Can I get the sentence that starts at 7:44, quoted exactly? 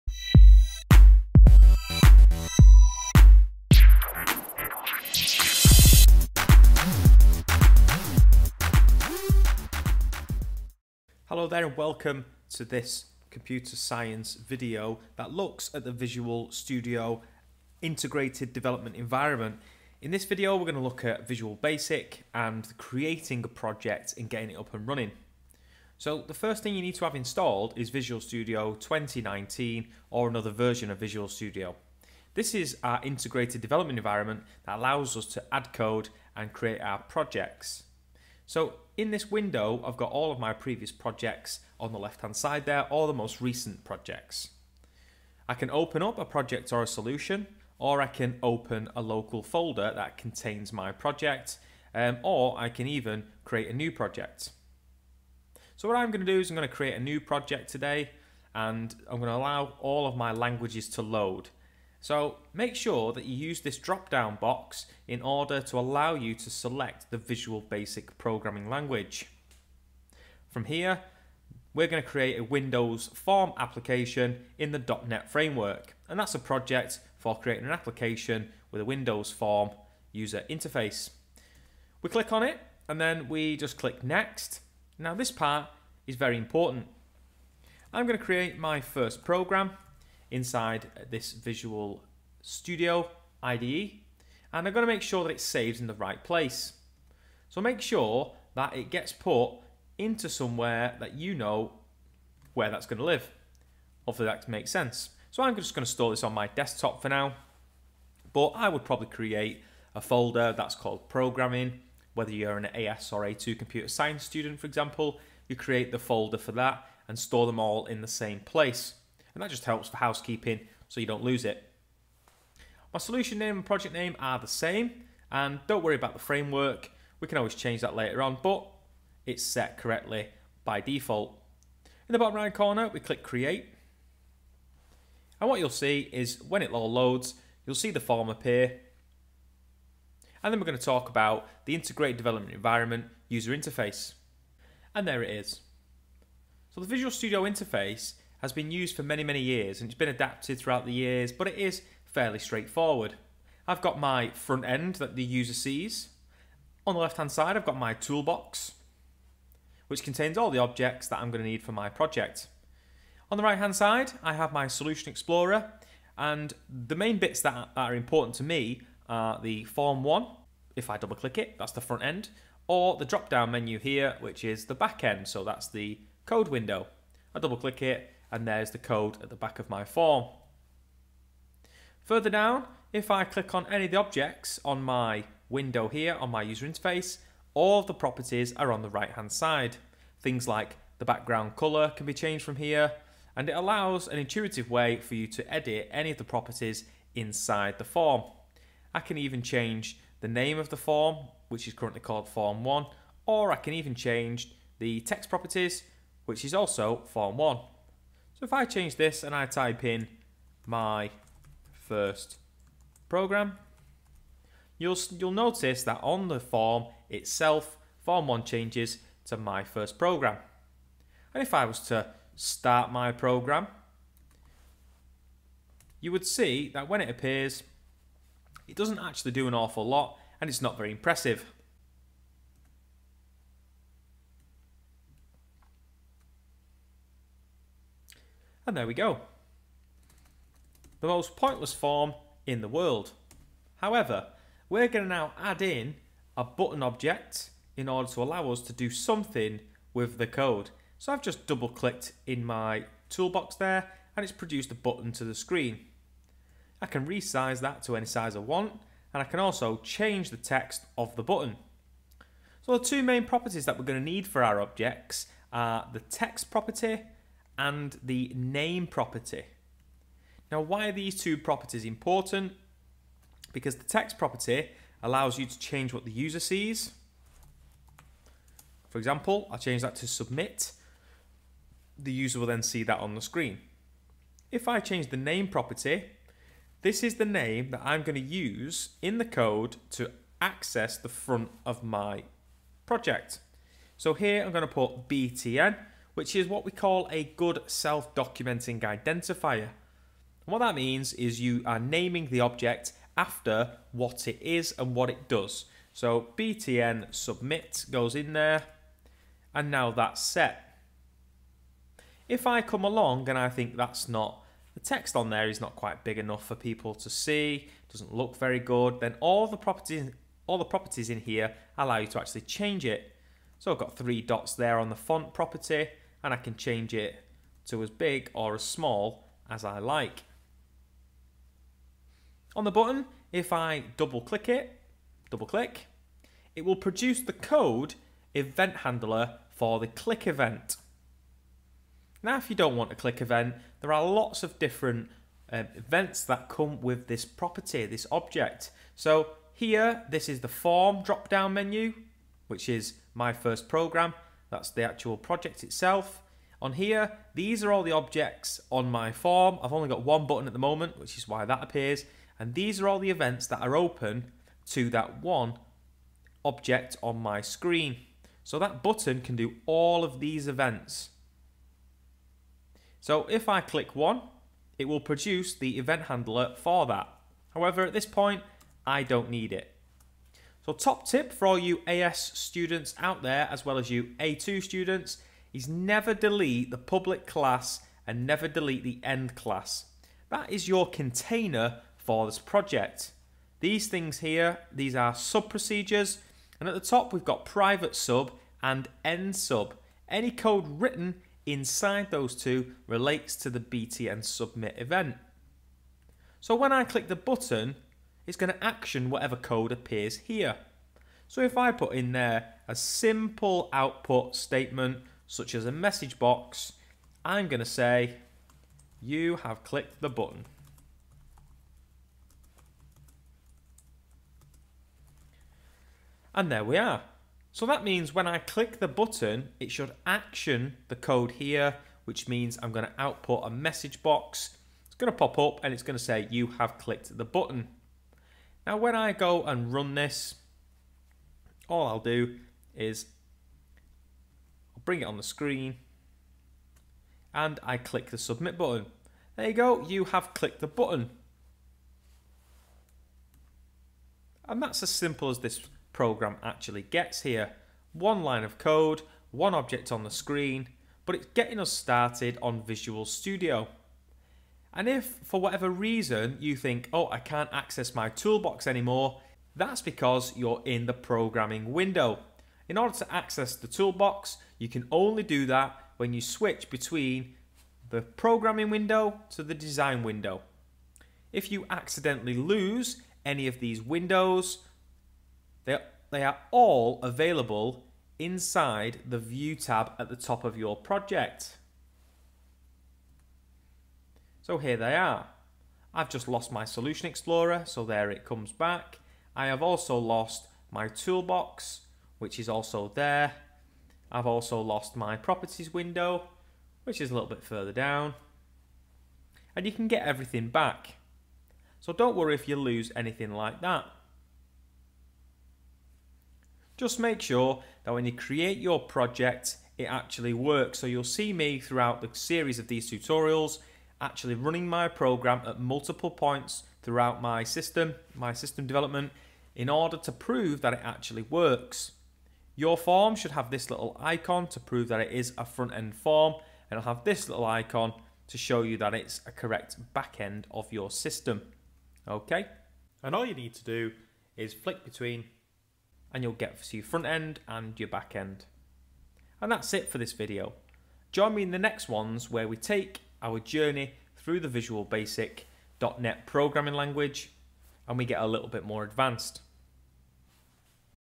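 And if, for whatever reason, you think, oh, I can't access my toolbox anymore, that's because you're in the programming window.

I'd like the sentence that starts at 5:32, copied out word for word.
On the button, if I double click it, double click, it will produce the code event handler for the click event.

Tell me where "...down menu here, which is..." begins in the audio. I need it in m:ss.
2:53.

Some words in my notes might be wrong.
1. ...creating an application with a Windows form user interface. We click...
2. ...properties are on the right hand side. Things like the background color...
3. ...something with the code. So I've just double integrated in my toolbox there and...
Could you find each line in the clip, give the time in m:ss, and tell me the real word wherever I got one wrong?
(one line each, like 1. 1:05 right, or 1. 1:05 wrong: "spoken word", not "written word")
1. 1:17 right
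2. 3:07 right
3. 4:08 wrong: "clicked", not "integrated".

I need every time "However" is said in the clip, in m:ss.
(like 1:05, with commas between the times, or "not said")
4:03, 6:17.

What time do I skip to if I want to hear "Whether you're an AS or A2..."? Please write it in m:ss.
1:52.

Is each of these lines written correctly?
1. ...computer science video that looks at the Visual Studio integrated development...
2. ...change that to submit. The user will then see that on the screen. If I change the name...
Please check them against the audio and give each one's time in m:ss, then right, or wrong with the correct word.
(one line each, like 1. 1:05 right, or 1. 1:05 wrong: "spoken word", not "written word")
1. 0:13 right
2. 4:39 right.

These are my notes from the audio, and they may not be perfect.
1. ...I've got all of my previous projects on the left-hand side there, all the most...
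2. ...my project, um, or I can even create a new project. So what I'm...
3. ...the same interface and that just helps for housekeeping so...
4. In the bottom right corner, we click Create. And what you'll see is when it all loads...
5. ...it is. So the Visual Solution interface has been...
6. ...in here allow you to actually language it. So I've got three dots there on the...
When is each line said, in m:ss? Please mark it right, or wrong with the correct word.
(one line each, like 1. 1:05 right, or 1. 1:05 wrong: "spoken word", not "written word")
1. 0:39 right
2. 0:50 right
3. 1:58 wrong: "place", not "interface"
4. 2:12 right
5. 2:25 wrong: "Studio", not "Solution"
6. 5:21 wrong: "change", not "language".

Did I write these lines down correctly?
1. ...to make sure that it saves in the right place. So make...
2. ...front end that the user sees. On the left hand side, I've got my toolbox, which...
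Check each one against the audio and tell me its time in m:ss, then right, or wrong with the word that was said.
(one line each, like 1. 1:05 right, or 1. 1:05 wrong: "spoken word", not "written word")
1. 1:34 right
2. 2:34 right.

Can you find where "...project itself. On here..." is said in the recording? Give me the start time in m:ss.
5:55.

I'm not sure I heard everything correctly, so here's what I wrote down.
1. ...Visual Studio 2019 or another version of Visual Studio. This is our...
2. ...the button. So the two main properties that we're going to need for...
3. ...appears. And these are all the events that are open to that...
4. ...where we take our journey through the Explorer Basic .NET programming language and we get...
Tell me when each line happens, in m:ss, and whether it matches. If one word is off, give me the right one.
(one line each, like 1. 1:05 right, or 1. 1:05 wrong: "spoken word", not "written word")
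1. 0:27 right
2. 4:21 right
3. 6:01 right
4. 9:12 wrong: "Visual", not "Explorer".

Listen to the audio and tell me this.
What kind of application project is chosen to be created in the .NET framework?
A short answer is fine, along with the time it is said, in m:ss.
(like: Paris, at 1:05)
Windows form application, at 1:12.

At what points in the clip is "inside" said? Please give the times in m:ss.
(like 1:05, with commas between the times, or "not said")
1:30, 3:17, 6:41, 8:08.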